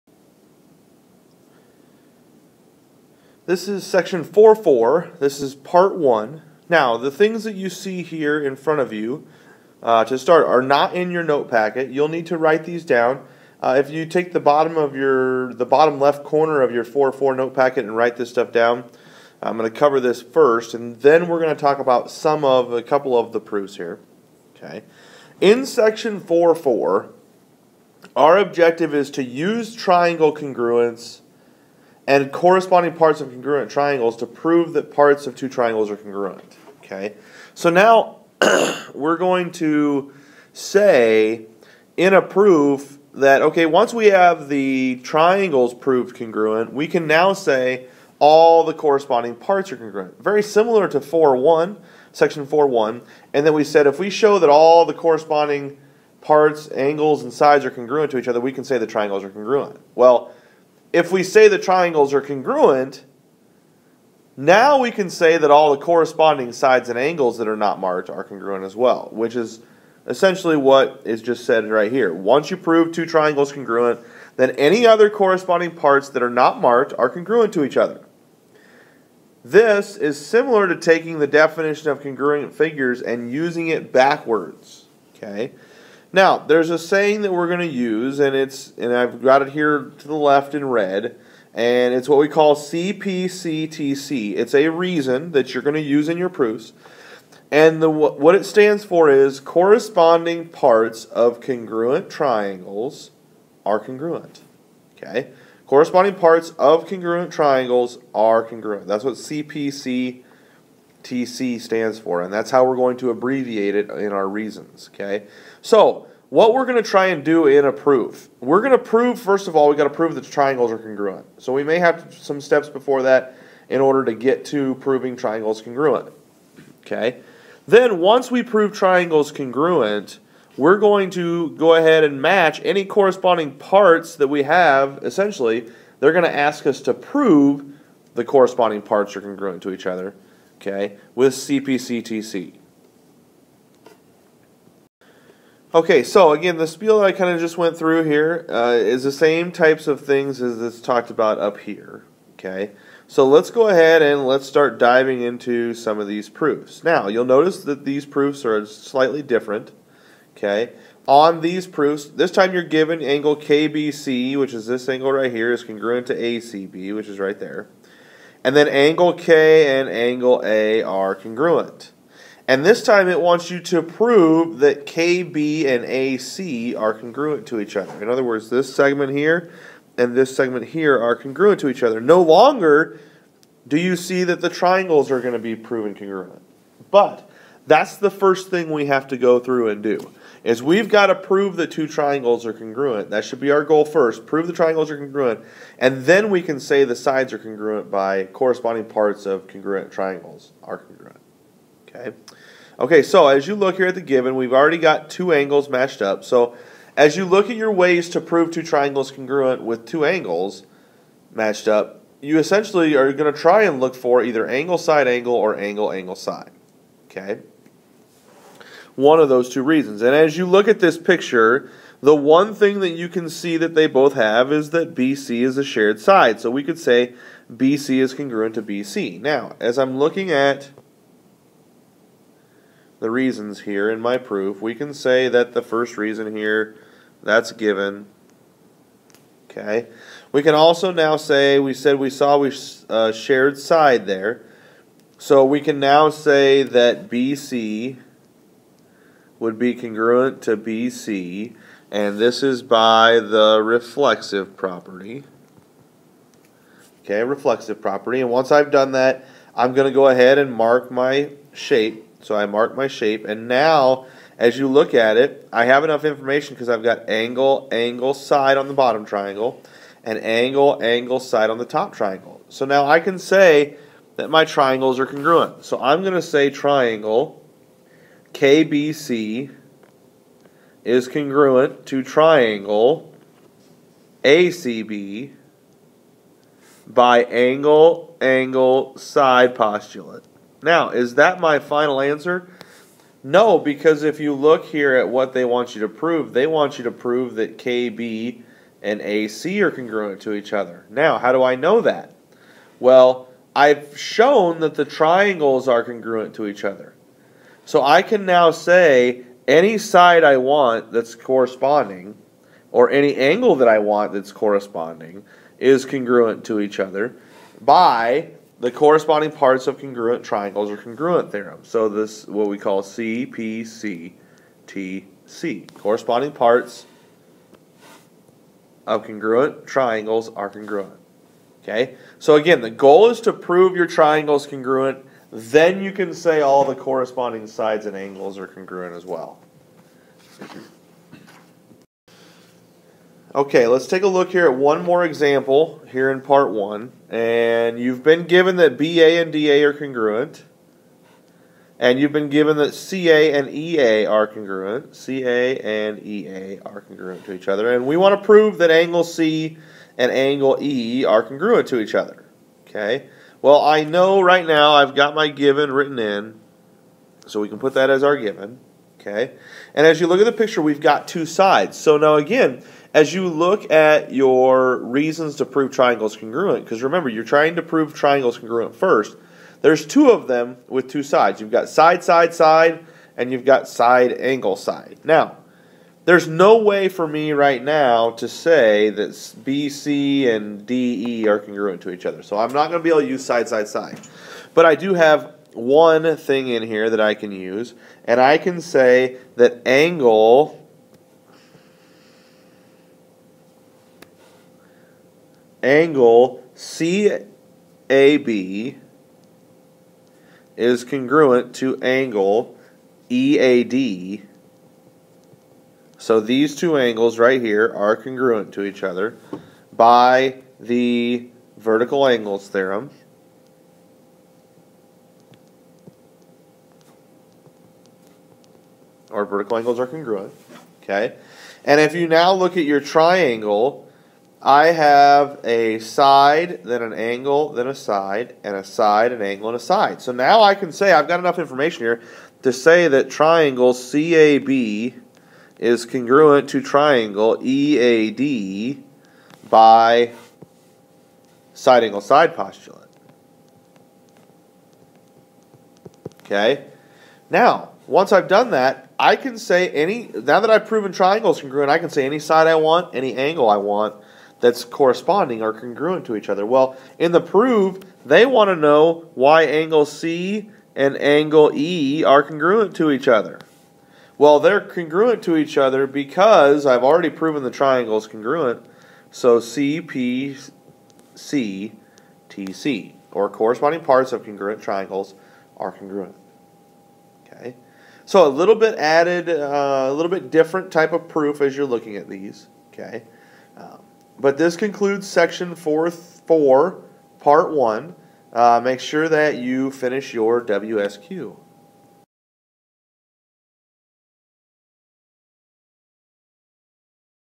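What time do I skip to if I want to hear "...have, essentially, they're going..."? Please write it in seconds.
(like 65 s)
134 s.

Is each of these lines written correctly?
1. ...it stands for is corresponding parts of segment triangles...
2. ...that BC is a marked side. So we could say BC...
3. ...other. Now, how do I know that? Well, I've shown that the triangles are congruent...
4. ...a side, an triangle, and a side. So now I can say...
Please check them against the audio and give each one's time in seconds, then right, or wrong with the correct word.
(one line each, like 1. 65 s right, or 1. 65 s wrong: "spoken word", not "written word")
1. 98 s wrong: "congruent", not "segment"
2. 224 s wrong: "shared", not "marked"
3. 300 s right
4. 438 s wrong: "angle", not "triangle".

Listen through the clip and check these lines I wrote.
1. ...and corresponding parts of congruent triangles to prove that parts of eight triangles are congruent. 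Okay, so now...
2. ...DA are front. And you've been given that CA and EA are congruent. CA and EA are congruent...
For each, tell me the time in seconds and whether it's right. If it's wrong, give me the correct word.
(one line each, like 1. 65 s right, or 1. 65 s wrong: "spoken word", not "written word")
1. 32 s wrong: "two", not "eight"
2. 349 s wrong: "congruent", not "front".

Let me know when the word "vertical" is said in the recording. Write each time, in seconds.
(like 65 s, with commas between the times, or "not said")
421 s, 429 s.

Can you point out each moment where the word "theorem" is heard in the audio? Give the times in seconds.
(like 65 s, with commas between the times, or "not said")
321 s, 422 s.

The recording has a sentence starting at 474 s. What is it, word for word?
Well, they're congruent to each other because I've already proven the triangle is congruent.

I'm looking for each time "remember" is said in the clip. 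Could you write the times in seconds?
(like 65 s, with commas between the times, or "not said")
376 s.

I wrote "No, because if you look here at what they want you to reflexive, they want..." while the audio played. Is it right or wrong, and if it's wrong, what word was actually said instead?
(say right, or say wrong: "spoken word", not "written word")
wrong: "prove", not "reflexive".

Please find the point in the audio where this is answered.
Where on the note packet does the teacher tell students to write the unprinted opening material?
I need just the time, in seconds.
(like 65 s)
15 s.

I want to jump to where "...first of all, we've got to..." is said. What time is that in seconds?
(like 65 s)
119 s.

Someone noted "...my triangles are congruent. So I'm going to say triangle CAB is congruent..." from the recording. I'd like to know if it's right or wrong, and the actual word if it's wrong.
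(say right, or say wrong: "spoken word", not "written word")
wrong: "KBC", not "CAB".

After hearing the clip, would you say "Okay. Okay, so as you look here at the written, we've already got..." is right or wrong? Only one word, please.
wrong.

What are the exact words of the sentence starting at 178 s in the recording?
In other words, this segment here and this segment here are congruent to each other.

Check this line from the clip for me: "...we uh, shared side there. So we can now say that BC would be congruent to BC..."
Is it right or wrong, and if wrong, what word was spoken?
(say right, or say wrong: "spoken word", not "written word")
right.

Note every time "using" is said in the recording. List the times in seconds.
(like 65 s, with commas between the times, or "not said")
83 s.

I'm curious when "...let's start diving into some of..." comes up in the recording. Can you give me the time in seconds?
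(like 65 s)
154 s.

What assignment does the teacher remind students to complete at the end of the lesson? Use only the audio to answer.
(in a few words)
WSQ.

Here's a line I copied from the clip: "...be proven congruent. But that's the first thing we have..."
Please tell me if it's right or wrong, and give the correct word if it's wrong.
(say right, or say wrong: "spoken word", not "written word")
right.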